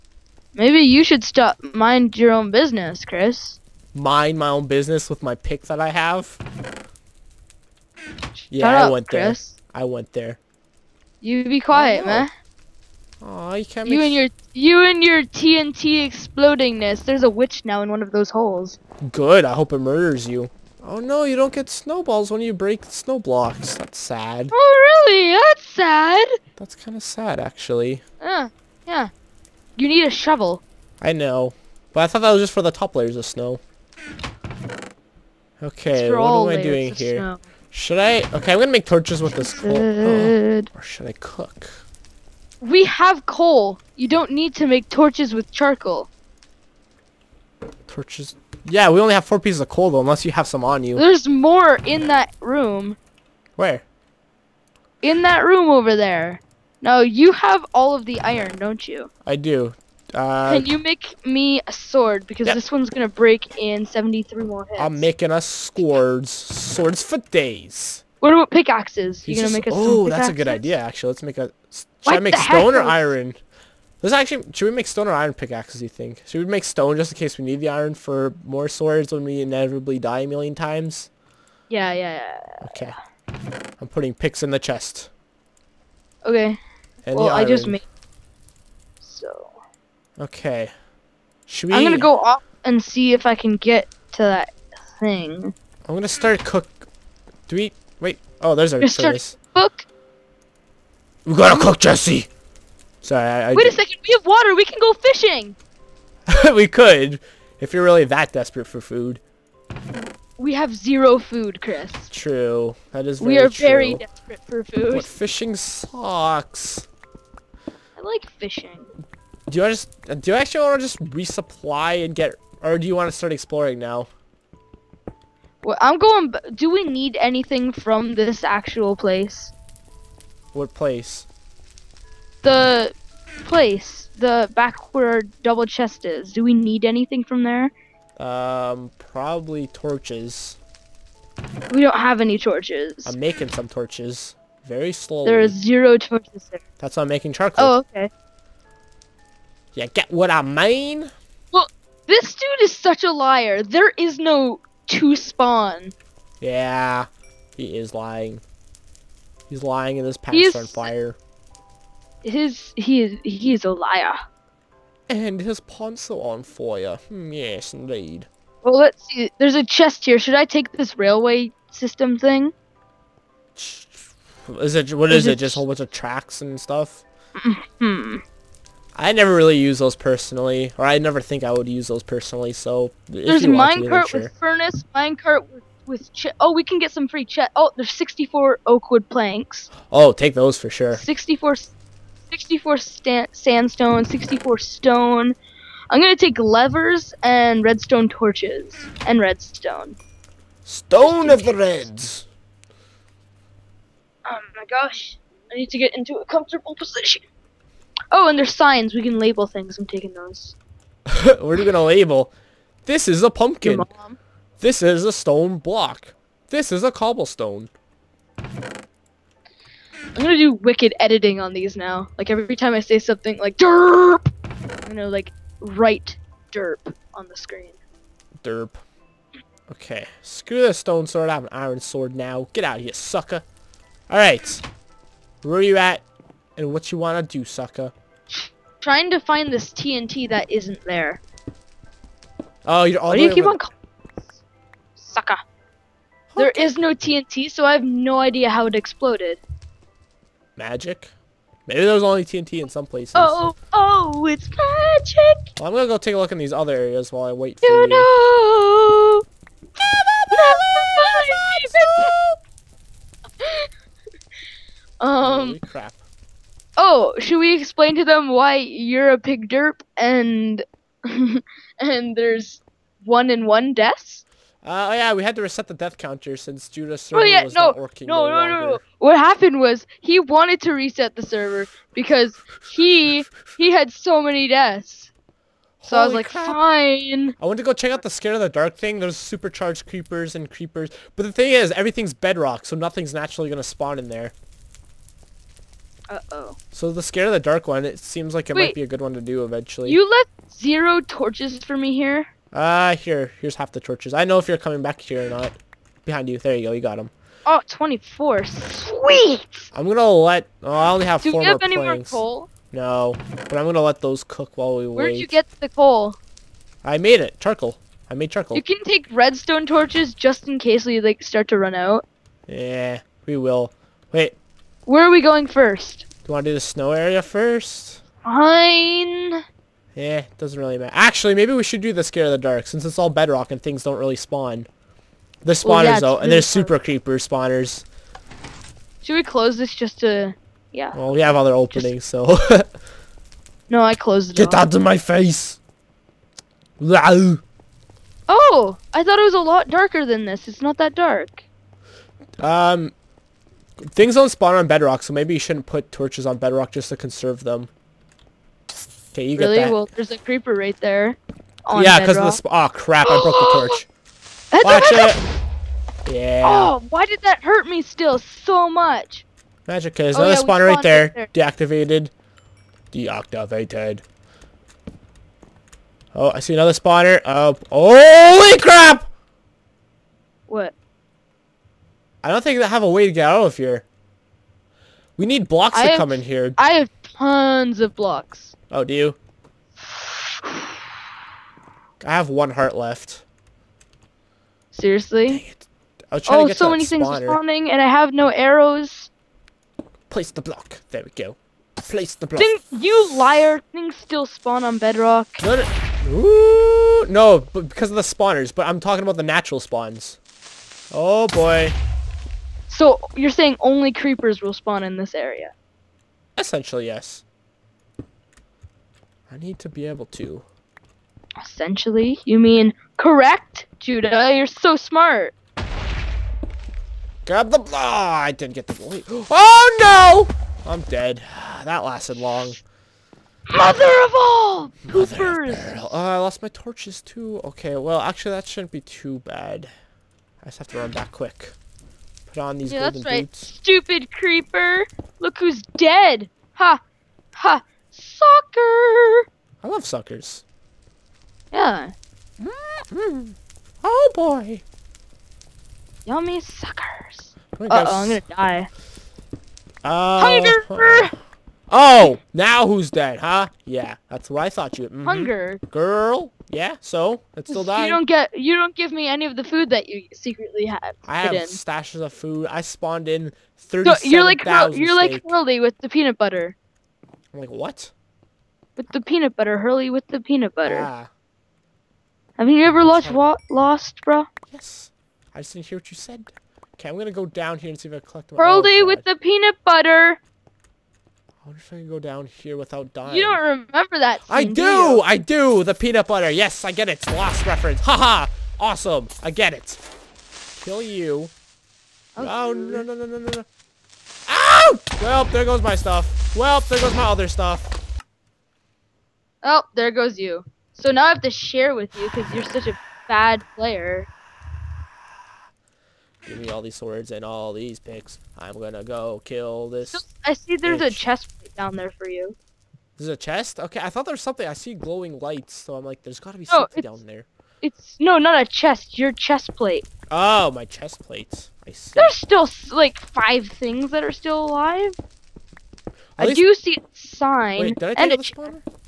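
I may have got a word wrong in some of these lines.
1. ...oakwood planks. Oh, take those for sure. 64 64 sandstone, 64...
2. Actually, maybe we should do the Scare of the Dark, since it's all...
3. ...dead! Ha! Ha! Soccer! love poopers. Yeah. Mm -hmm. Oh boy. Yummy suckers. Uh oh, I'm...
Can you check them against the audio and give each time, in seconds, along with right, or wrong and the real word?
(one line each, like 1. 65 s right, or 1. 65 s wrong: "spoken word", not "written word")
1. 188 s right
2. 330 s right
3. 445 s wrong: "suckers", not "poopers".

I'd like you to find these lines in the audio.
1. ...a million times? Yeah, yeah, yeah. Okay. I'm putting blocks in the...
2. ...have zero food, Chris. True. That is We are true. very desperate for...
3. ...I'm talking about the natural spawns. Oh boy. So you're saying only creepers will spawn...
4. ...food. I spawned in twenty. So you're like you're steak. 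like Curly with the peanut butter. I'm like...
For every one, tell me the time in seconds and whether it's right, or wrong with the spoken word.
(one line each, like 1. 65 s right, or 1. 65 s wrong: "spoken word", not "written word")
1. 80 s wrong: "picks", not "blocks"
2. 110 s right
3. 408 s right
4. 472 s wrong: "thirty", not "twenty".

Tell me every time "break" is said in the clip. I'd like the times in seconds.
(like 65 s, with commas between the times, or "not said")
22 s, 63 s.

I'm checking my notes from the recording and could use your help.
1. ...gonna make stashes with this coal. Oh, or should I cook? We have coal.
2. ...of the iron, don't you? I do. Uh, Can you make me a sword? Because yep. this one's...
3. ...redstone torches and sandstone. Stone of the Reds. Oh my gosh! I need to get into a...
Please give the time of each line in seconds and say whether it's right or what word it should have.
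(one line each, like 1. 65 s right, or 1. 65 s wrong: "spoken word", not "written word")
1. 38 s wrong: "torches", not "stashes"
2. 57 s right
3. 197 s wrong: "redstone", not "sandstone".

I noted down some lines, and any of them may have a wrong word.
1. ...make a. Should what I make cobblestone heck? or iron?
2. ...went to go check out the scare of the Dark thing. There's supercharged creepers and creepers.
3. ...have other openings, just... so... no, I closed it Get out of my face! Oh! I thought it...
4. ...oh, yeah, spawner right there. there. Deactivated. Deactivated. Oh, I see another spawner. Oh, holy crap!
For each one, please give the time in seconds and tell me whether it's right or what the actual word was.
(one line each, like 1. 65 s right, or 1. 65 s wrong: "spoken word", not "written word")
1. 71 s wrong: "stone", not "cobblestone"
2. 287 s right
3. 341 s right
4. 370 s right.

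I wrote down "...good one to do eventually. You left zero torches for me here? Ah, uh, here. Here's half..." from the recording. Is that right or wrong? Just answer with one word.
right.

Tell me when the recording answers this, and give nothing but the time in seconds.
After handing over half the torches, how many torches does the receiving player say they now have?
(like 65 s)
307 s.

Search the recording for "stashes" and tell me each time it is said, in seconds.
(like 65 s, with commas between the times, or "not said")
471 s.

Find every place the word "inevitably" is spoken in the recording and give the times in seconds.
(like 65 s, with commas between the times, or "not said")
79 s.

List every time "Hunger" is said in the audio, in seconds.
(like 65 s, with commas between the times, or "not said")
460 s, 465 s.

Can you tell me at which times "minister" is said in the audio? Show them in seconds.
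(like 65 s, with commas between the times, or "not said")
not said.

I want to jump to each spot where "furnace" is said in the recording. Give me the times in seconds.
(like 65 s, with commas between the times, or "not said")
98 s, 184 s.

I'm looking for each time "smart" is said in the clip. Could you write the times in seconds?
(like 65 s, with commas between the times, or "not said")
424 s.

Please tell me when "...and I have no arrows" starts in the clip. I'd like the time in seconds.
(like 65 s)
397 s.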